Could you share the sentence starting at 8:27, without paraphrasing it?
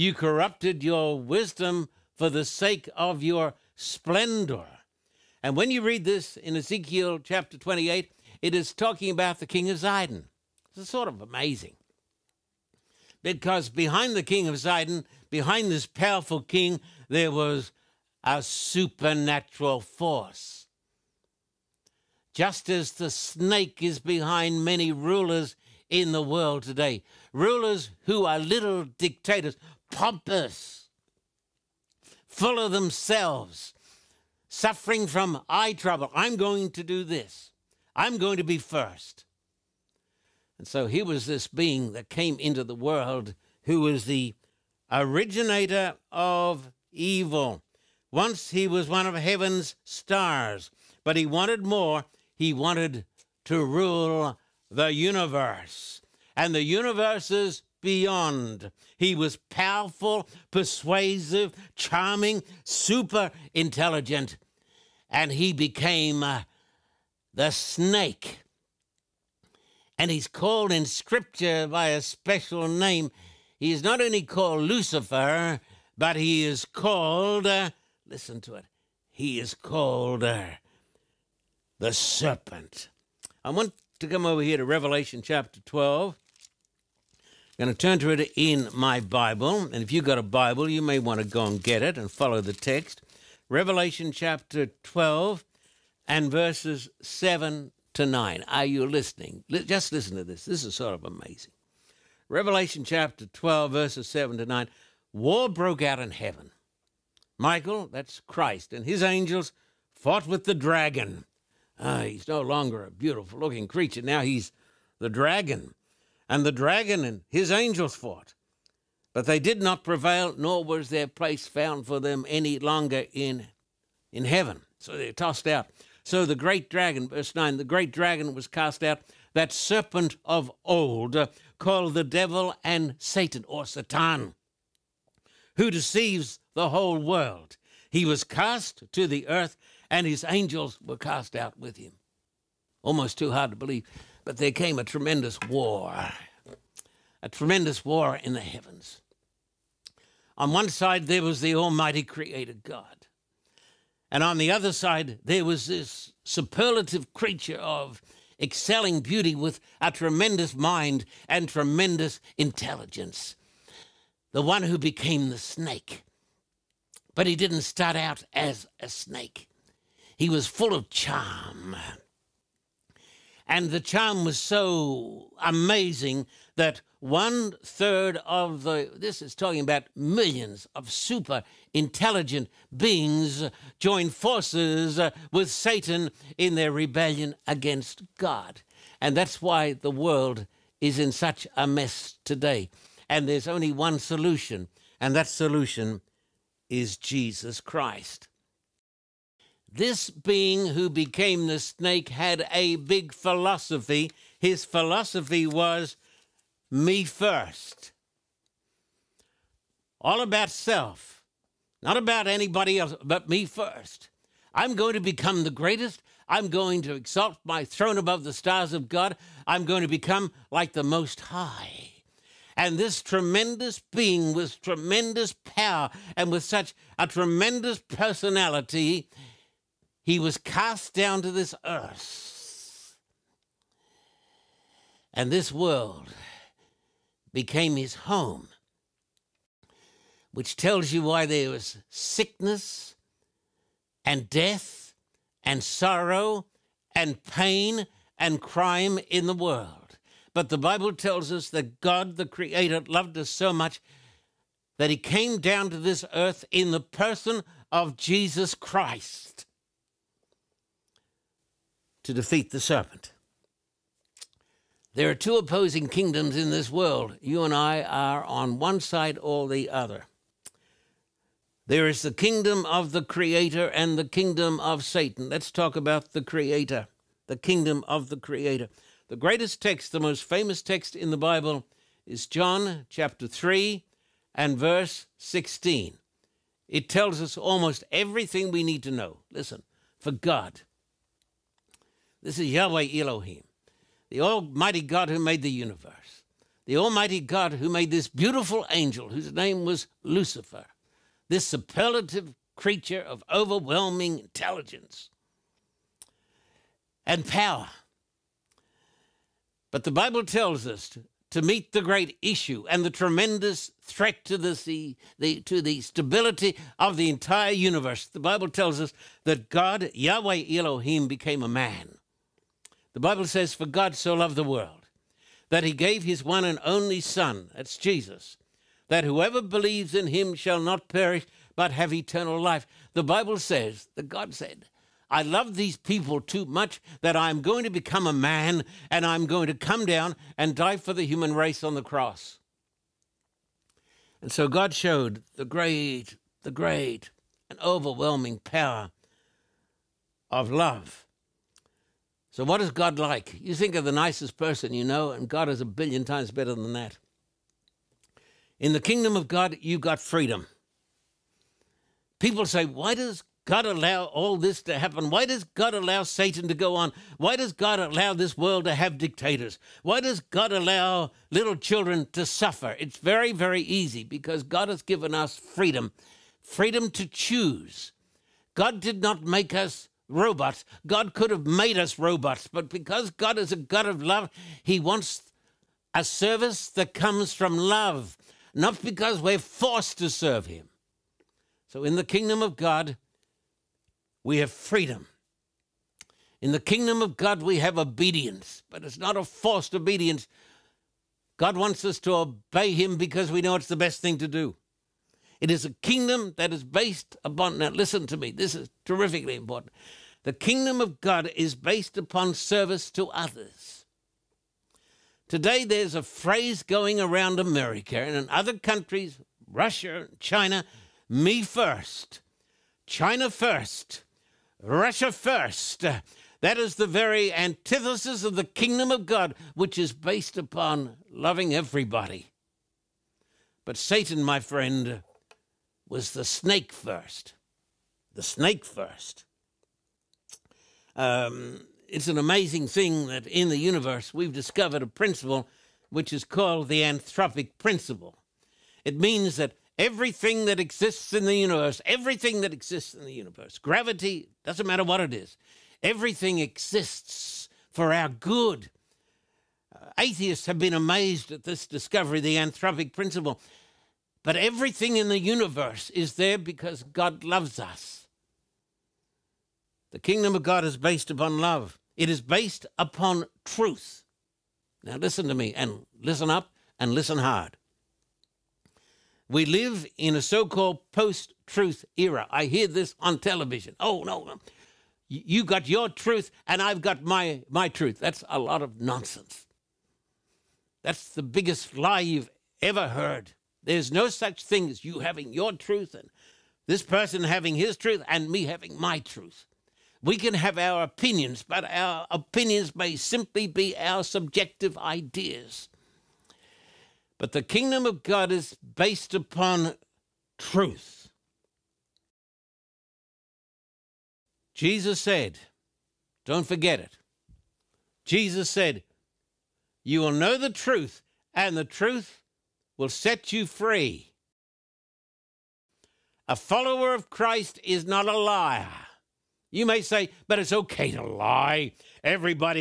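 But the kingdom of God is based upon truth.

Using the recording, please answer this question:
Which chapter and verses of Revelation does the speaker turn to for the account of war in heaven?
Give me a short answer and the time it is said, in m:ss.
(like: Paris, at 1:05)
Chapter 12, verses 7 to 9, at 1:33.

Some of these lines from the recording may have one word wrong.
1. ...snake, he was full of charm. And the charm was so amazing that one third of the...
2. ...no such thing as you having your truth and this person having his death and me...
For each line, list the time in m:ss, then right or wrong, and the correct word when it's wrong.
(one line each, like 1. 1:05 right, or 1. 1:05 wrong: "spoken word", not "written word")
1. 2:48 right
2. 8:13 wrong: "truth", not "death".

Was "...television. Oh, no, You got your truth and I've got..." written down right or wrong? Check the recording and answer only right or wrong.
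right.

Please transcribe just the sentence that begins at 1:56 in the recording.
And the dragon and his angels fought.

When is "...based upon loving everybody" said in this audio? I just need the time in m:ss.
7:09.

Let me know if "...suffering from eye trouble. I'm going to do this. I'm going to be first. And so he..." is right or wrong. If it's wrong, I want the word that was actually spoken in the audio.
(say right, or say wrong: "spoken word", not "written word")
right.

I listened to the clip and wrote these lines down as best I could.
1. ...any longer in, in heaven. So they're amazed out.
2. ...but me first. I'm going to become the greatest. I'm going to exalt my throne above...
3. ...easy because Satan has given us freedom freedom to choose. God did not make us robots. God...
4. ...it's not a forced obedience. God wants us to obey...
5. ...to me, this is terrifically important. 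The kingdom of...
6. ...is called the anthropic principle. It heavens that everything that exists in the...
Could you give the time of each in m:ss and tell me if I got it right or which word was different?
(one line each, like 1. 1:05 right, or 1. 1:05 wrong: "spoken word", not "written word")
1. 2:02 wrong: "tossed", not "amazed"
2. 3:33 right
3. 6:13 wrong: "God", not "Satan"
4. 6:38 right
5. 6:48 right
6. 7:26 wrong: "means", not "heavens".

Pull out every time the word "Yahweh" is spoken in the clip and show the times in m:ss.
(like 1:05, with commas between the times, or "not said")
4:52, 5:19.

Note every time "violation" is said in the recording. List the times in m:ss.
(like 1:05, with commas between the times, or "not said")
not said.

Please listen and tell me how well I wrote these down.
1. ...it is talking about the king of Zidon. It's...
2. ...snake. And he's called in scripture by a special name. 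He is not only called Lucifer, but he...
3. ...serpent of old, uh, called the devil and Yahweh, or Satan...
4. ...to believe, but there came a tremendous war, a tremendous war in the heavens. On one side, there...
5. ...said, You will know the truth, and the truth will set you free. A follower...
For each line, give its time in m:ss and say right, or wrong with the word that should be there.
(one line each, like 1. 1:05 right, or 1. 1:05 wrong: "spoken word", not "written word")
1. 0:08 right
2. 1:07 right
3. 2:09 wrong: "Satan", not "Yahweh"
4. 2:23 right
5. 8:38 right.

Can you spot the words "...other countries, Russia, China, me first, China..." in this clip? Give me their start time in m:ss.
6:58.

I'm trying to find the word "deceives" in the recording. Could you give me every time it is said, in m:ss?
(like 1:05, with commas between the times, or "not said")
2:15.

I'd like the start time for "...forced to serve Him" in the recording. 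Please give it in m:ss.
6:29.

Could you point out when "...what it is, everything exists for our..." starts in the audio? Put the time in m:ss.
7:34.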